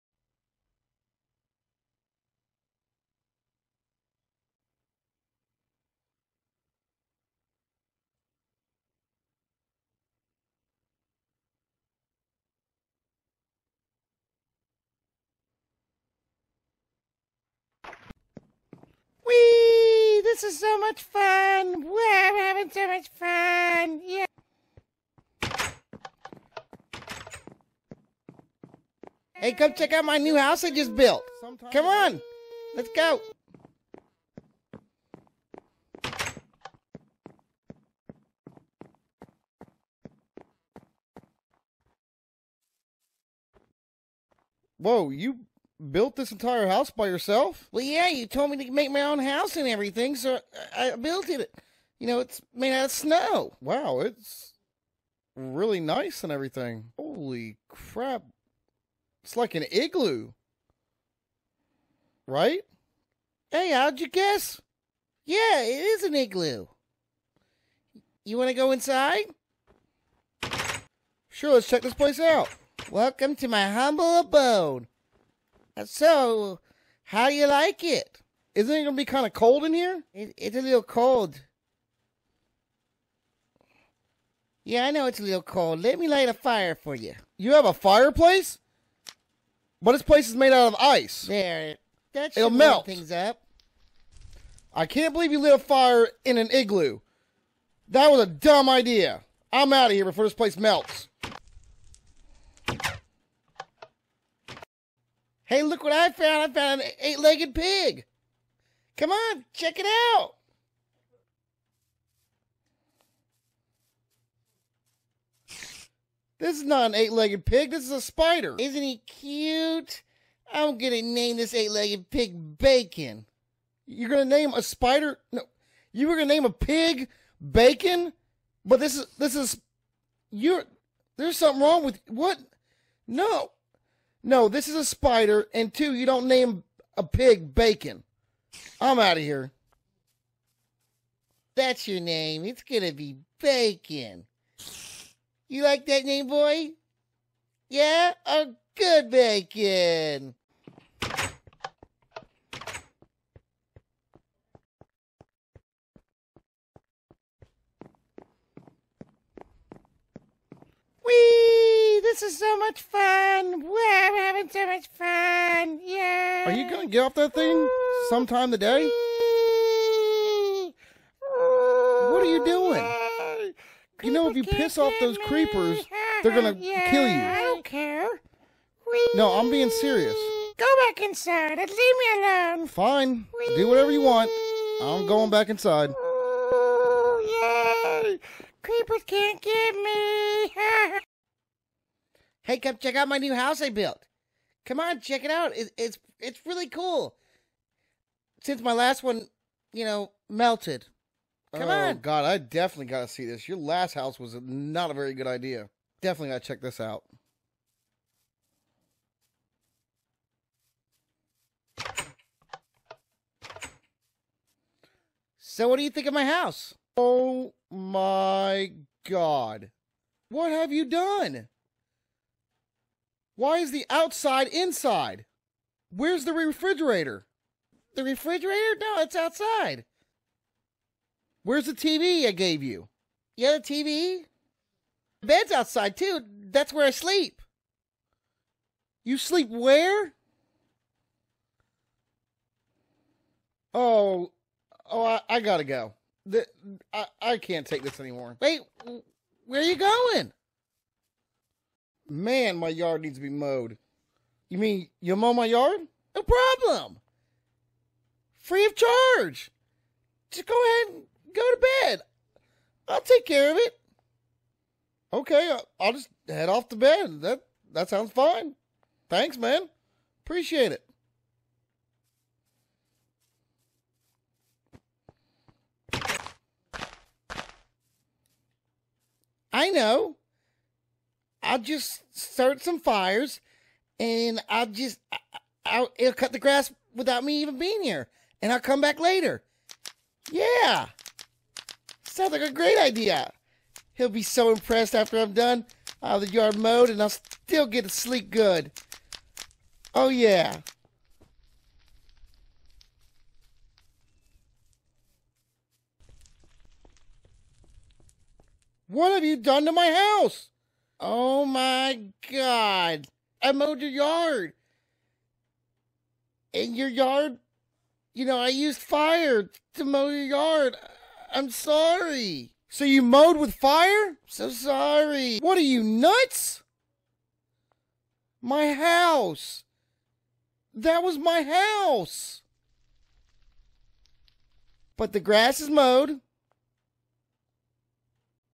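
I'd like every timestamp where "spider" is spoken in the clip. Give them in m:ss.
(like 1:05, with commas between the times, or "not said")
1:57, 2:04, 2:14.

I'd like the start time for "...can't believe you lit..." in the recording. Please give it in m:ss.
1:34.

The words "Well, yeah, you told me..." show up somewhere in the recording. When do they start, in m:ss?
0:47.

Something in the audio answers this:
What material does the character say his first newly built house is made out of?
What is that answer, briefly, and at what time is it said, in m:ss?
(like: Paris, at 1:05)
Snow, at 0:52.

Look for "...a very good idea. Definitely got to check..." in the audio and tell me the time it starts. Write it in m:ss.
3:24.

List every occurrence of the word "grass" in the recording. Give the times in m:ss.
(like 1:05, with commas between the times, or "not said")
4:46, 5:35.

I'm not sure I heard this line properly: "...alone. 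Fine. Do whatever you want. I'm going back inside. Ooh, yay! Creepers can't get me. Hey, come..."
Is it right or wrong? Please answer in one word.
right.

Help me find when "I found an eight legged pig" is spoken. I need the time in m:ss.
1:46.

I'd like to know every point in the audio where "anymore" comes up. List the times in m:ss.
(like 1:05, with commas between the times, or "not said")
4:07.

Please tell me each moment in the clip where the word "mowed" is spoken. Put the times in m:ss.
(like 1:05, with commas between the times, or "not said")
4:13, 4:56, 5:13, 5:23, 5:35.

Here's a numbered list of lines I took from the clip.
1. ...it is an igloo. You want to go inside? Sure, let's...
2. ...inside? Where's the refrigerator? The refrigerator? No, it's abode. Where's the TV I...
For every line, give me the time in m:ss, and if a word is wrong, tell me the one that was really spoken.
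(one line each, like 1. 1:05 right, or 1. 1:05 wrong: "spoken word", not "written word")
1. 1:05 right
2. 3:44 wrong: "outside", not "abode".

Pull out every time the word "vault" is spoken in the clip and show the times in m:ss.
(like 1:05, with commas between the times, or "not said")
not said.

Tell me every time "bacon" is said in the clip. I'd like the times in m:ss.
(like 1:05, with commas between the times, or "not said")
2:02, 2:07, 2:17, 2:23, 2:29.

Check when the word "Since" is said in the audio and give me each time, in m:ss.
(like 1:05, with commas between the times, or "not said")
3:18.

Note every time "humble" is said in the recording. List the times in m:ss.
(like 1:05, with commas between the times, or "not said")
1:13.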